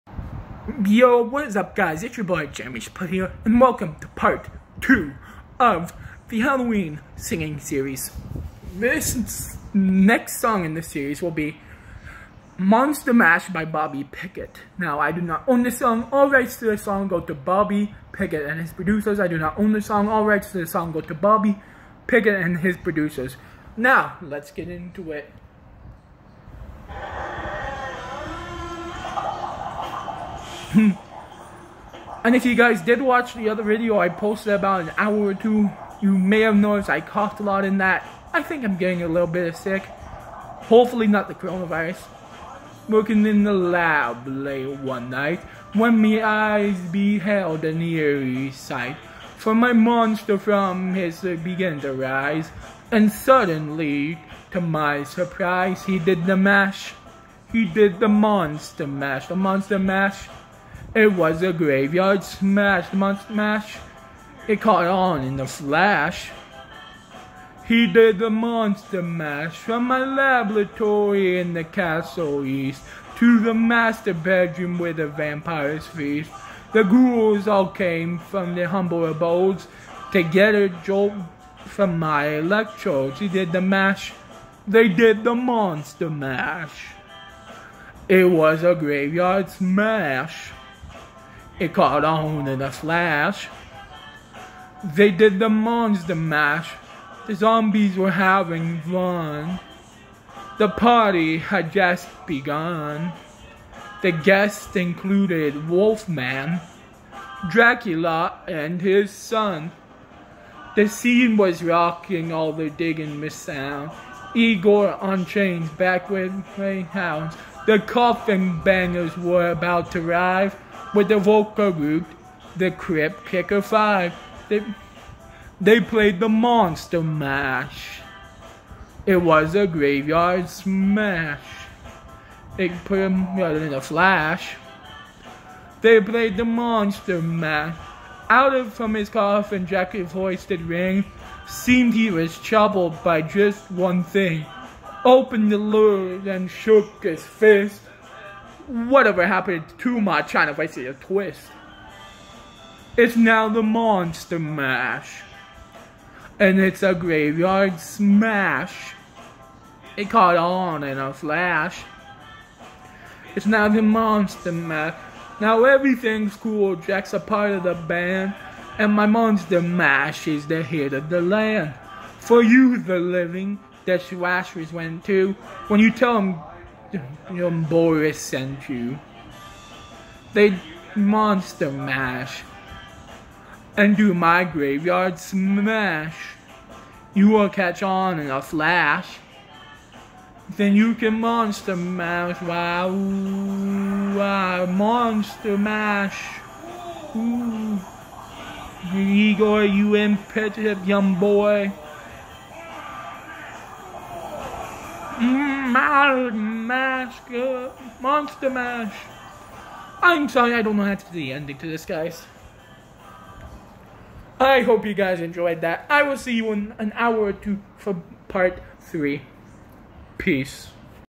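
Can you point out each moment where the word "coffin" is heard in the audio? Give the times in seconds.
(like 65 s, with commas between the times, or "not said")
117 s, 139 s.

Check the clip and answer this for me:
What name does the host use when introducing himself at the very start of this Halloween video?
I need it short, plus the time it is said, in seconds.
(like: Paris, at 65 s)
Jeremy Split, at 2 s.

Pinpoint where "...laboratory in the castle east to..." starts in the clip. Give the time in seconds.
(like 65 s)
70 s.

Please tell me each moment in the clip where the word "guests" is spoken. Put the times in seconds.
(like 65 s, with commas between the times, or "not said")
104 s.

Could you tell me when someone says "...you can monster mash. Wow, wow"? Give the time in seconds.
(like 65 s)
190 s.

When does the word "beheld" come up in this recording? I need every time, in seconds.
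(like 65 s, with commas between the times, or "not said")
46 s.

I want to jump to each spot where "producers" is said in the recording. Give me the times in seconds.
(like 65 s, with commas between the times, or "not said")
18 s, 22 s.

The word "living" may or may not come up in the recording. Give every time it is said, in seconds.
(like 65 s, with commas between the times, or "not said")
172 s.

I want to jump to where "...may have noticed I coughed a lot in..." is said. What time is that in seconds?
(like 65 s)
36 s.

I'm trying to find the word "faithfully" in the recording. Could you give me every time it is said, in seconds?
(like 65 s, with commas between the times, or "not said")
not said.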